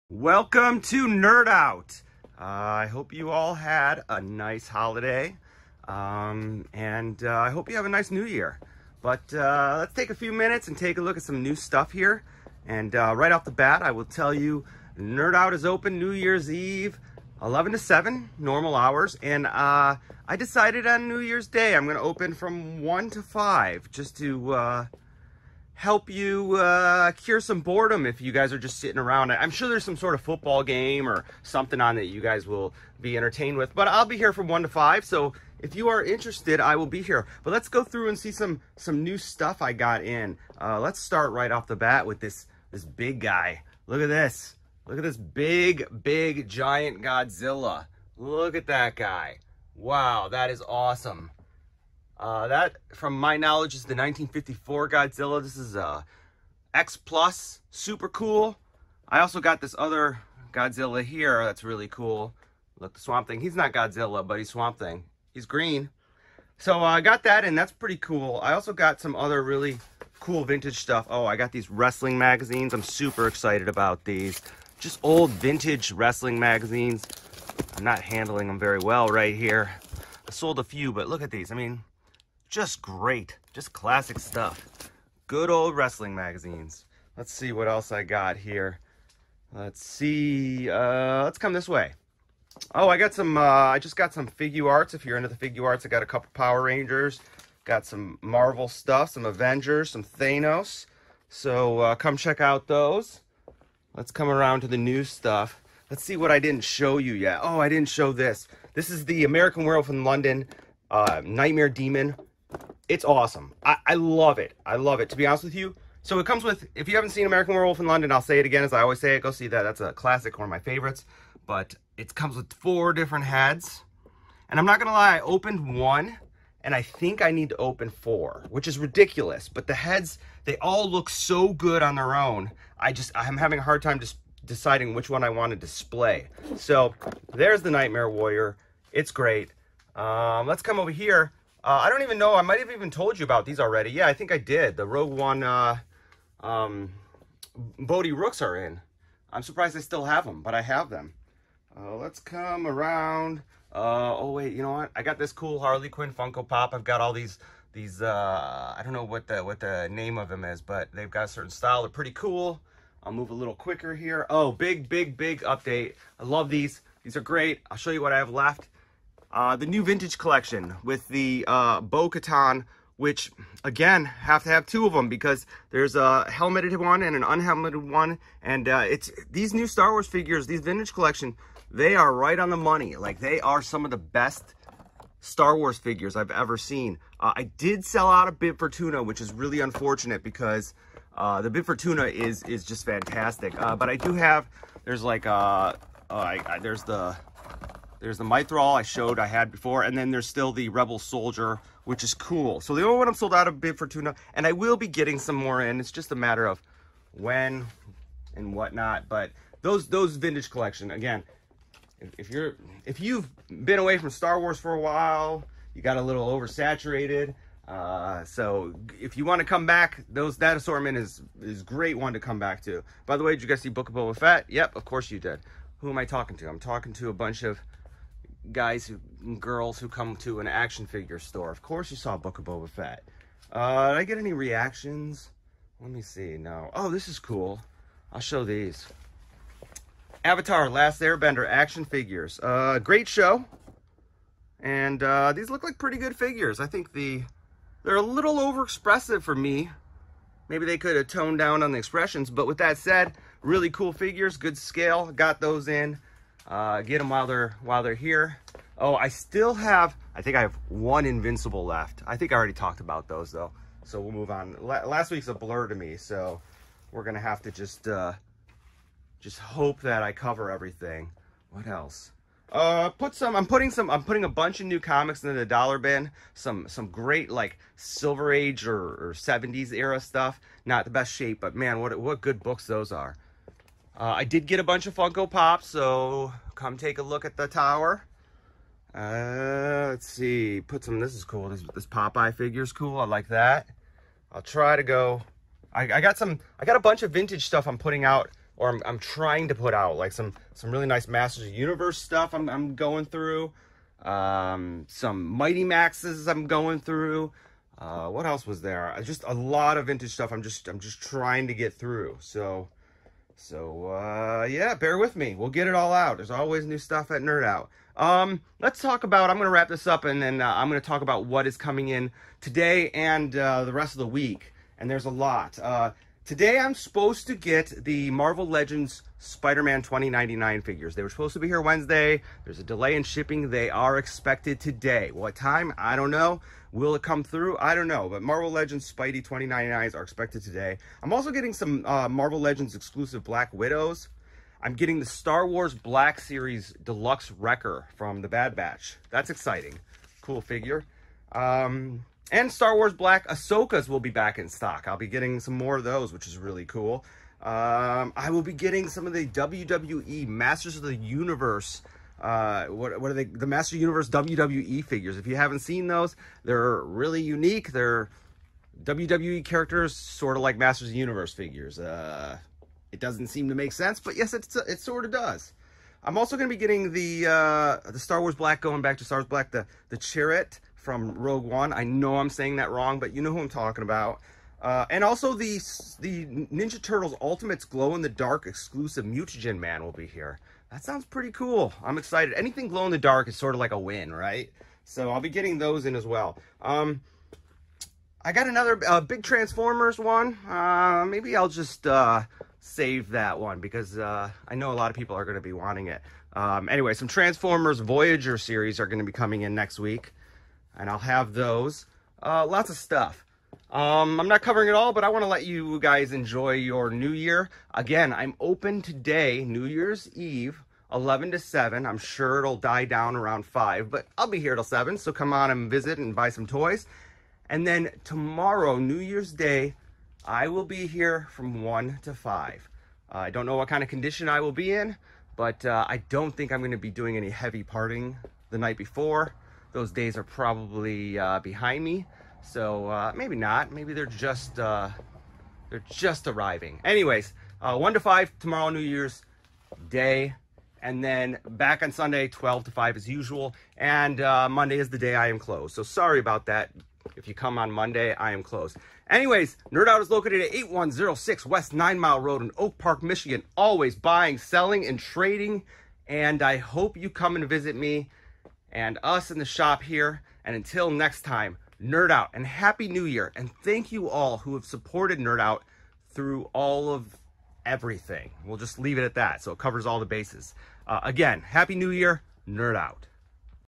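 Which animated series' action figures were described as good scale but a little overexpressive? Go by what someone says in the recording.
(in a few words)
Avatar Last Airbender.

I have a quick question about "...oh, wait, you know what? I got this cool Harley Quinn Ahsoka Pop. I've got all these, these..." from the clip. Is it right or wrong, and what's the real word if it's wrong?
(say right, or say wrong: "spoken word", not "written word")
wrong: "Funko", not "Ahsoka".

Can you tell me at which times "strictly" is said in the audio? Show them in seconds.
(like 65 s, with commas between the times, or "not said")
not said.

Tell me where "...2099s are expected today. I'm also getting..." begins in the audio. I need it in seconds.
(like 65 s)
339 s.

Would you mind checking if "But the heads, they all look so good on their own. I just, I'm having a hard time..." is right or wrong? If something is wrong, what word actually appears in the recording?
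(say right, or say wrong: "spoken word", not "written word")
right.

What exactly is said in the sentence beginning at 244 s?
And uh, these look like pretty good figures.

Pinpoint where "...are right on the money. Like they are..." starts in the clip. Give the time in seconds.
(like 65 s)
181 s.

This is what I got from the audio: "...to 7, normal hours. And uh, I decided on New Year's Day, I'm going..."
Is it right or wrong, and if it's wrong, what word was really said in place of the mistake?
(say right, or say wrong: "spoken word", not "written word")
right.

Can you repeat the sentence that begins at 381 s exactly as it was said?
I know I'm saying that wrong, but you know who I'm talking about.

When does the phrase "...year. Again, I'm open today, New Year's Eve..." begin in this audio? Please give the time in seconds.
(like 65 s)
417 s.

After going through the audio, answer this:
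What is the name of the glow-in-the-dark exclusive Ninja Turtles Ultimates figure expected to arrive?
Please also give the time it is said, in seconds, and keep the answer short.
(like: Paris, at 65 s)
Mutagen Man, at 389 s.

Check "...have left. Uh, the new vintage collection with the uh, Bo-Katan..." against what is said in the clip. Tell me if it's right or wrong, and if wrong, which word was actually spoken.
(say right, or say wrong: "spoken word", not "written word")
right.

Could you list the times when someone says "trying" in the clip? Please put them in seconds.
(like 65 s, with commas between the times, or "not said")
298 s, 311 s.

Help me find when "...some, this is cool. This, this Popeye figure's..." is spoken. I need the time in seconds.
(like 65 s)
290 s.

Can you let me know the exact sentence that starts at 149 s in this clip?
I'm surprised I still have them, but I have them.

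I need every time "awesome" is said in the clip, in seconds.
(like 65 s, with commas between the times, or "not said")
50 s, 113 s.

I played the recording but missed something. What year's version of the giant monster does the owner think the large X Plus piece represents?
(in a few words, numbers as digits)
1954.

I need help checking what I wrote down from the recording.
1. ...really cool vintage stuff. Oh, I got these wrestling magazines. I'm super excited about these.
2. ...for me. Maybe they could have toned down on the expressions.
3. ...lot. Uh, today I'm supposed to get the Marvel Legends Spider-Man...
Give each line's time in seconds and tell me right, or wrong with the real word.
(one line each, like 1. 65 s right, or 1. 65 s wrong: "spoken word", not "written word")
1. 69 s right
2. 249 s right
3. 325 s right.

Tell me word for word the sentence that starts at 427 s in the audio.
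And then tomorrow, New Year's Day, I will be here from 1 to 5.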